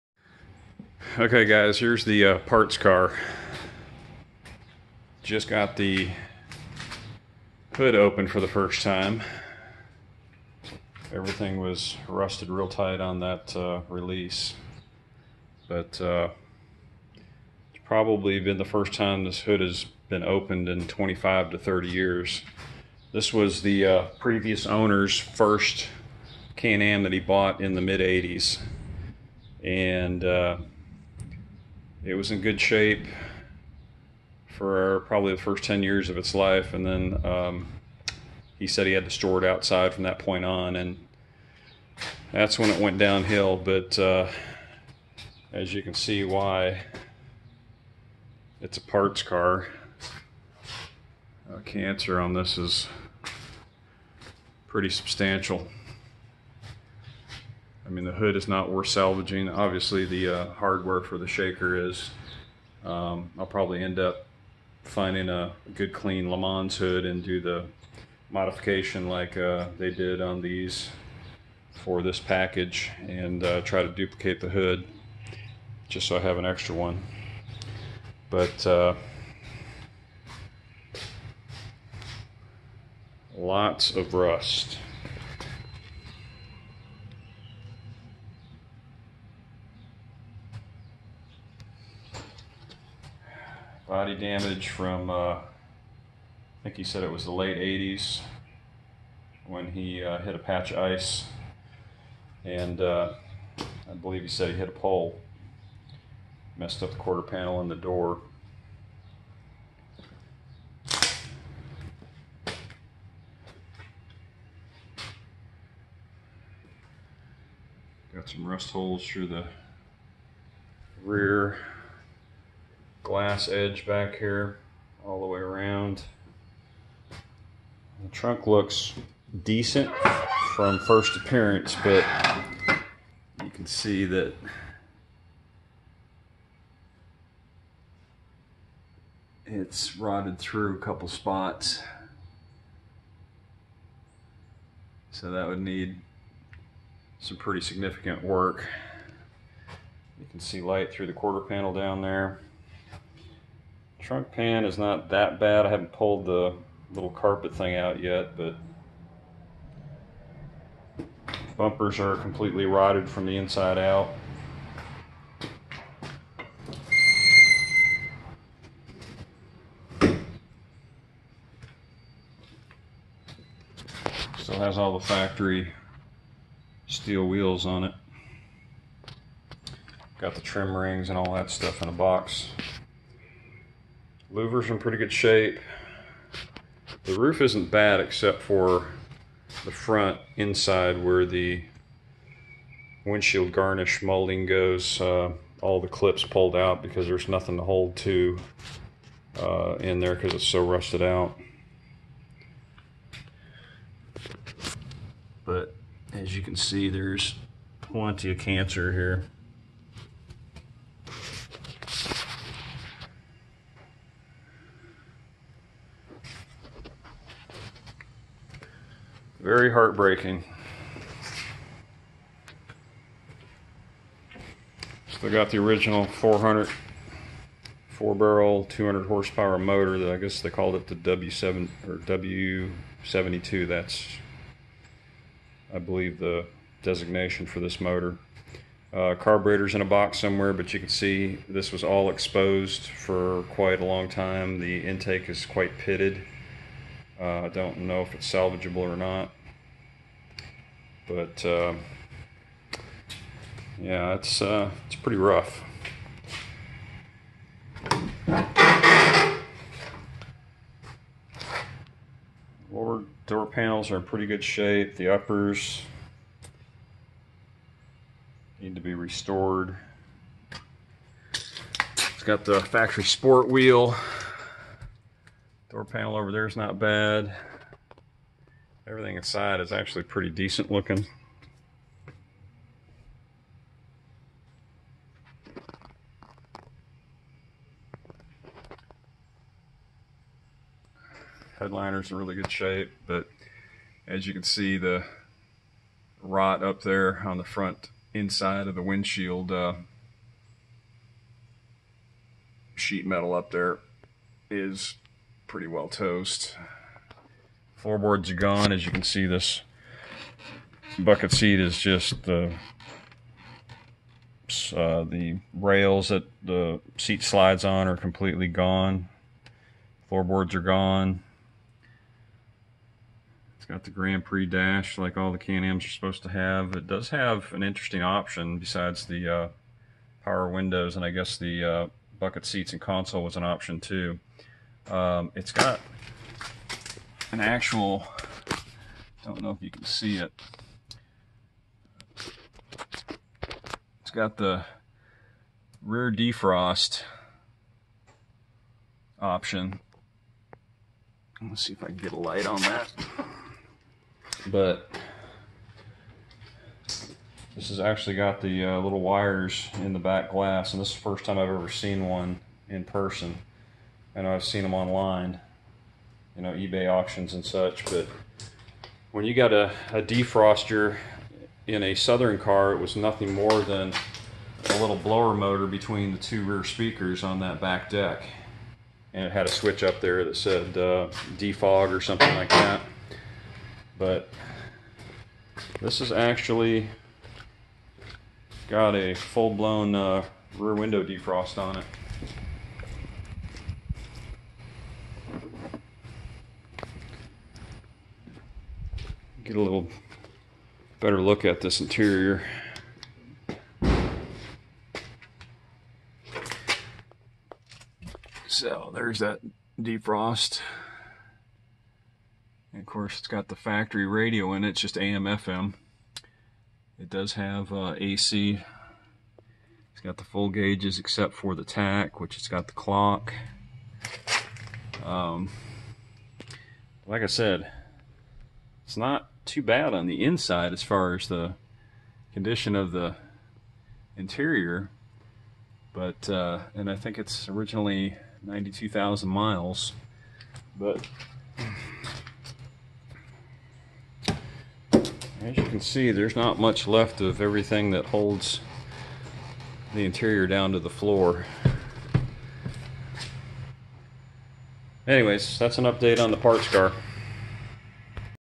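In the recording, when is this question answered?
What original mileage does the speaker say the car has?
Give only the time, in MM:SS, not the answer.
07:18.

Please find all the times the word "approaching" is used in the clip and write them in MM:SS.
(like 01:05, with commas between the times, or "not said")
not said.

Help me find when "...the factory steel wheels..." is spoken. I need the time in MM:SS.
02:54.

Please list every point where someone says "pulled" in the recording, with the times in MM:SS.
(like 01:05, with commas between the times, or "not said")
02:35, 03:16.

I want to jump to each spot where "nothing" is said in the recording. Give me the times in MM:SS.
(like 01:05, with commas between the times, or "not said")
03:17, 06:12.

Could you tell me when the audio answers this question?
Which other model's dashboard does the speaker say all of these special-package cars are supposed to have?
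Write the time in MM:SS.
05:23.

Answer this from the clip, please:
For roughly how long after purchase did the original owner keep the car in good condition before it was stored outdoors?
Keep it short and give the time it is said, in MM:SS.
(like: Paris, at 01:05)
first 10 years, at 00:35.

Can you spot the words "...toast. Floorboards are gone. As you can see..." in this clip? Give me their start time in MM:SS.
05:05.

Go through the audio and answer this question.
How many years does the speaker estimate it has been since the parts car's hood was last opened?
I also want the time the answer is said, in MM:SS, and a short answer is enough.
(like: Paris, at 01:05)
25 to 30 years, at 00:20.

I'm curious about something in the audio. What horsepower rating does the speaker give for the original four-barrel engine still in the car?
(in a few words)
200 horsepower.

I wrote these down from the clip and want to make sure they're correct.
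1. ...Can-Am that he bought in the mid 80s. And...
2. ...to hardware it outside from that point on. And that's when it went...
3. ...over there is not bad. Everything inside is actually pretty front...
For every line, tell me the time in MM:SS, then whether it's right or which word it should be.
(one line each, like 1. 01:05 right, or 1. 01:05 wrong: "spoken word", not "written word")
1. 00:26 right
2. 00:39 wrong: "store", not "hardware"
3. 04:36 wrong: "decent", not "front".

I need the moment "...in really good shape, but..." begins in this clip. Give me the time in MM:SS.
04:52.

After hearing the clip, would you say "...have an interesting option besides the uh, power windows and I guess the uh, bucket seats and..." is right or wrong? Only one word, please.
right.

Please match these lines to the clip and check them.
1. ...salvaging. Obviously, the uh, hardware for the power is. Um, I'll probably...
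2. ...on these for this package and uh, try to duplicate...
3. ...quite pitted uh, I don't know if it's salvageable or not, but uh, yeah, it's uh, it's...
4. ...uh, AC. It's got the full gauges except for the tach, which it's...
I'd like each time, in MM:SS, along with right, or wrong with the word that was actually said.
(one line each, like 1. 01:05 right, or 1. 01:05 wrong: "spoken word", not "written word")
1. 00:58 wrong: "shaker", not "power"
2. 01:10 right
3. 04:05 right
4. 06:57 right.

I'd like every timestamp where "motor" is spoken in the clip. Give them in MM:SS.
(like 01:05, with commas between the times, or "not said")
03:49, 03:57, 06:15.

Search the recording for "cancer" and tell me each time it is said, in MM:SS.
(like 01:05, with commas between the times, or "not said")
00:51, 03:28.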